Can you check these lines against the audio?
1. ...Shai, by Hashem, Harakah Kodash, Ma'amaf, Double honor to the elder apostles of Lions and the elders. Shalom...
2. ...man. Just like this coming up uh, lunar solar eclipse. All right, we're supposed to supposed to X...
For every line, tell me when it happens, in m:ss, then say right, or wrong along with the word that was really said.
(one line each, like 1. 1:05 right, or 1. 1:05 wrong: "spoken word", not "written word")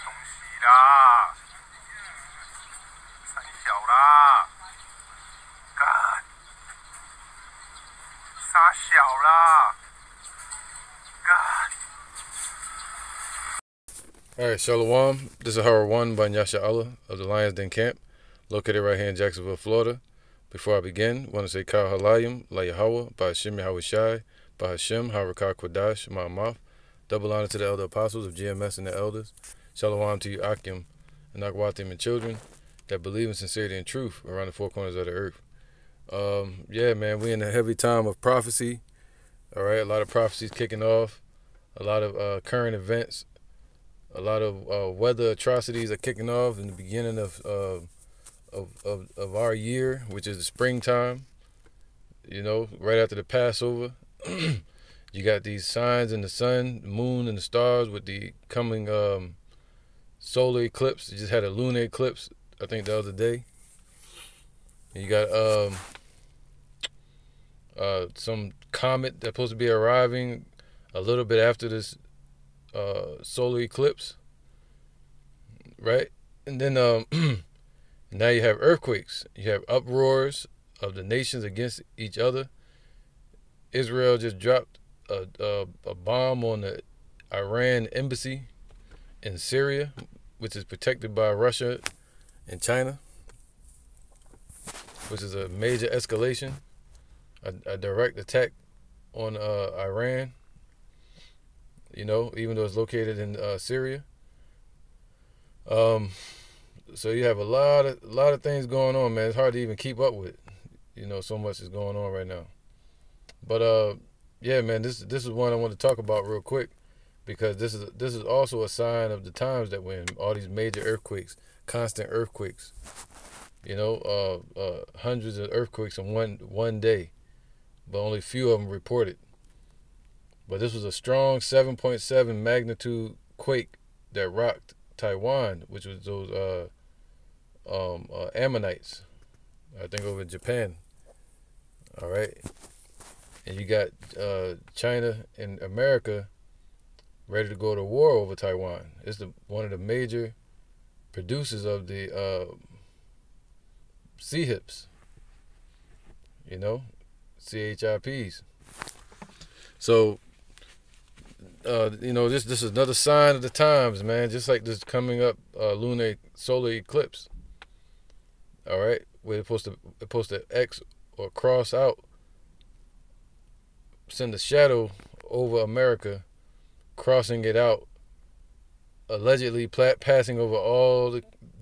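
1. 0:23 wrong: "GMS", not "Lions"
2. 2:44 right.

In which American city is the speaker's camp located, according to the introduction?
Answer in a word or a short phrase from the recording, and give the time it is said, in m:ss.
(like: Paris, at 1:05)
Jacksonville, Florida, at 0:19.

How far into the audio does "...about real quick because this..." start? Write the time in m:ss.
1:55.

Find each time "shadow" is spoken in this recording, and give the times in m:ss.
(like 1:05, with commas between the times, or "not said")
2:54.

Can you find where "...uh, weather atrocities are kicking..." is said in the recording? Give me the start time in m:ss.
0:44.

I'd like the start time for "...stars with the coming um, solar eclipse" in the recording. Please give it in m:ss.
0:57.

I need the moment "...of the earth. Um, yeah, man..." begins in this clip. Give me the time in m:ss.
0:34.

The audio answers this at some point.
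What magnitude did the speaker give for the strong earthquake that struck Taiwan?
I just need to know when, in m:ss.
2:11.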